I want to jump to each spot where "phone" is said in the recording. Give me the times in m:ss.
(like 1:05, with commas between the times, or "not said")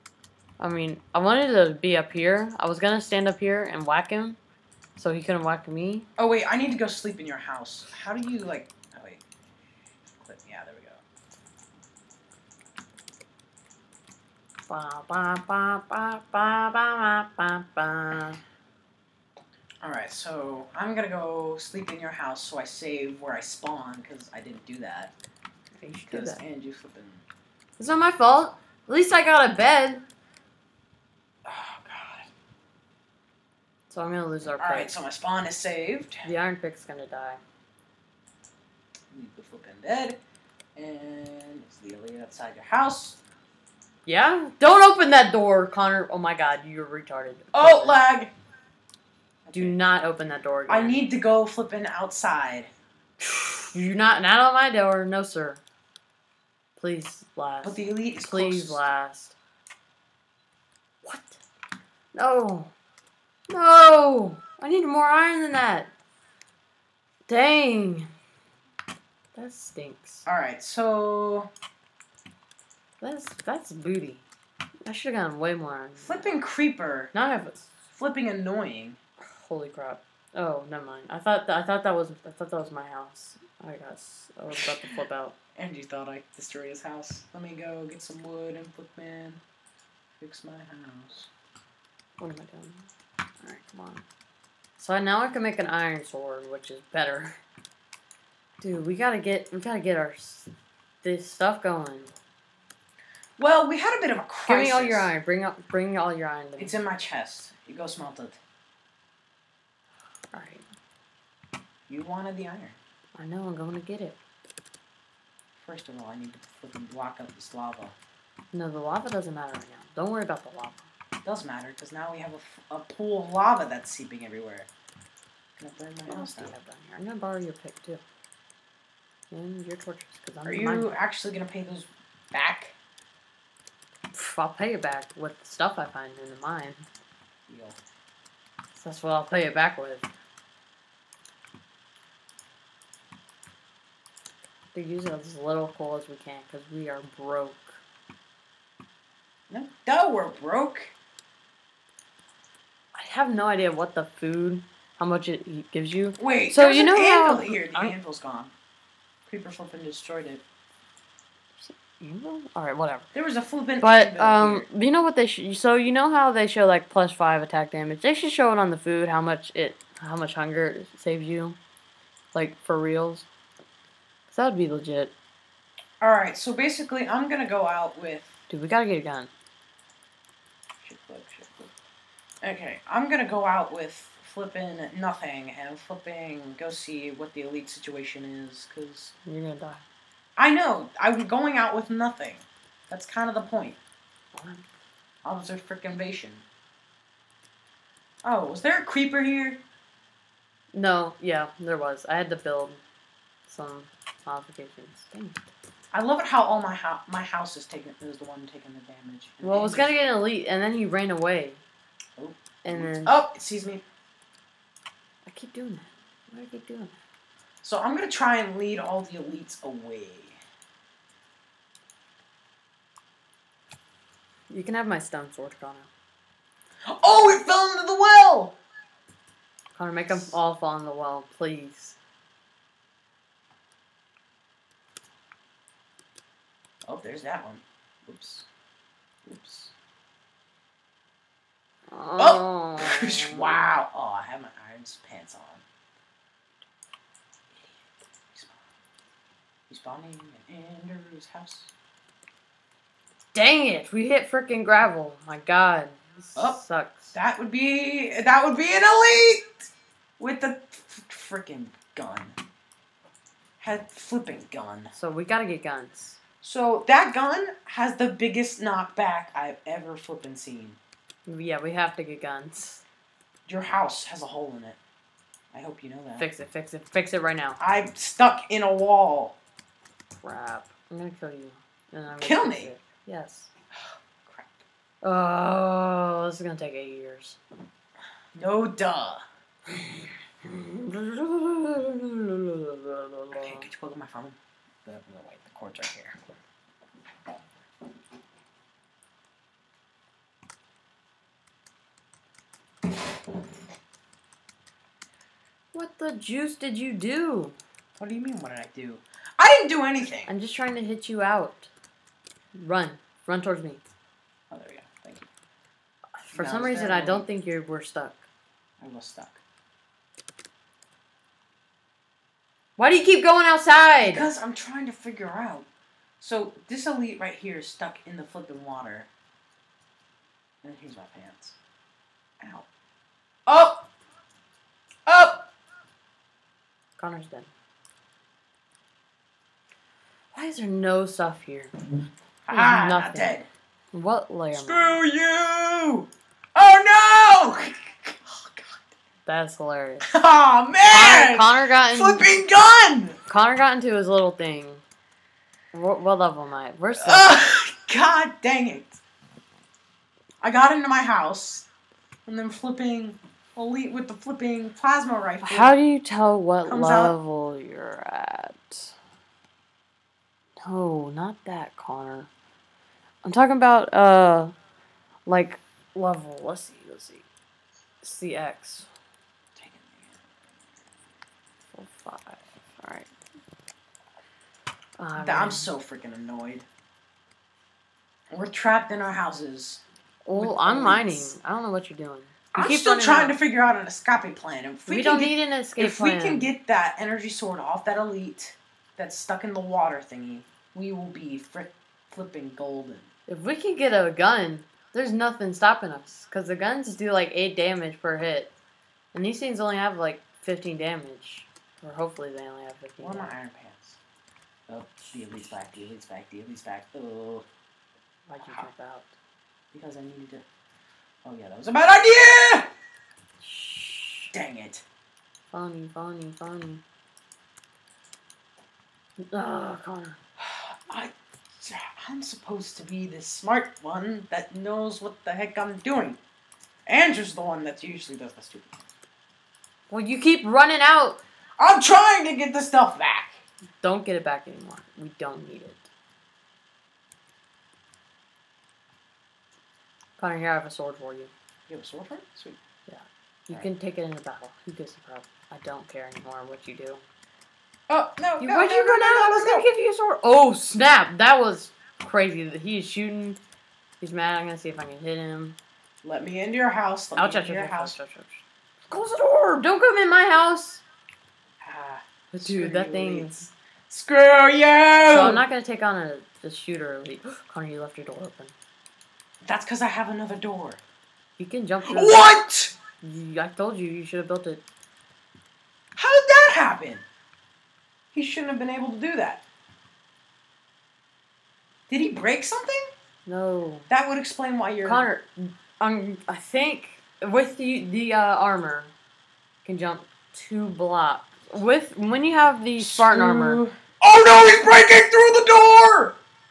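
4:54.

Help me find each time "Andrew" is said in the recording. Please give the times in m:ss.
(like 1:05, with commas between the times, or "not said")
4:10, 7:16.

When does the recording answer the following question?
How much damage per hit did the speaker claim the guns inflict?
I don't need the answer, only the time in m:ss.
6:47.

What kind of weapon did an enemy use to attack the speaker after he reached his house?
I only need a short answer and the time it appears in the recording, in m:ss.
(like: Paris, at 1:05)
Plasma rifle, at 6:04.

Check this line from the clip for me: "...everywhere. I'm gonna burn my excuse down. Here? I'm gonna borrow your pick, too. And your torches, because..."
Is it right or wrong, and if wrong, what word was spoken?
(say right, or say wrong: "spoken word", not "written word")
wrong: "house", not "excuse".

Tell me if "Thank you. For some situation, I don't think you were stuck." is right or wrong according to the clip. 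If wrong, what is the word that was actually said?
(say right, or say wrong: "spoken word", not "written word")
wrong: "reason", not "situation".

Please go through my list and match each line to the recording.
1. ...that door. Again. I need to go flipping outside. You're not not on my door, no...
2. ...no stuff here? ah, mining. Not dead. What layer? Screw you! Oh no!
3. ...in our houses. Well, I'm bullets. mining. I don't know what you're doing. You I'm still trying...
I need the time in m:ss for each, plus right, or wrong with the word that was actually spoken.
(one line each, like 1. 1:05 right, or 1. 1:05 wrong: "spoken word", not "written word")
1. 0:50 right
2. 5:40 wrong: "nothing", not "mining"
3. 6:28 right.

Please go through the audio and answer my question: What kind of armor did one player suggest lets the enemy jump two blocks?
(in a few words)
Spartan armor.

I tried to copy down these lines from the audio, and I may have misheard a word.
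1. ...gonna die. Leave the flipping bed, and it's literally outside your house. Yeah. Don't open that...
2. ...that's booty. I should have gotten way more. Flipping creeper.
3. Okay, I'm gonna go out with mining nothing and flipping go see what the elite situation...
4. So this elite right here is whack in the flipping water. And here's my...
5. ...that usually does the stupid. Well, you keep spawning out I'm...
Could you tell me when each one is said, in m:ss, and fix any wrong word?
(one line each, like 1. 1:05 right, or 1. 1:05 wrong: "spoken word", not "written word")
1. 0:36 right
2. 1:13 right
3. 3:02 wrong: "flipping", not "mining"
4. 5:26 wrong: "stuck", not "whack"
5. 7:17 wrong: "running", not "spawning".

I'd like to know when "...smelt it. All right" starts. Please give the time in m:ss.
1:47.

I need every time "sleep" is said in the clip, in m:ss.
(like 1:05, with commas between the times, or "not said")
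0:06, 0:21.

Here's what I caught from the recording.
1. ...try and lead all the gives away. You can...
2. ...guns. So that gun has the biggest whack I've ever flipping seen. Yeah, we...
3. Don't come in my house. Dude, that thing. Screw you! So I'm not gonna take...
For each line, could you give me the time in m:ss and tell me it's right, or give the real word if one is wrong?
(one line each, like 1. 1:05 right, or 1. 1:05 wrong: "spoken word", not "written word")
1. 3:38 wrong: "elites", not "gives"
2. 4:25 wrong: "knockback", not "whack"
3. 7:49 right.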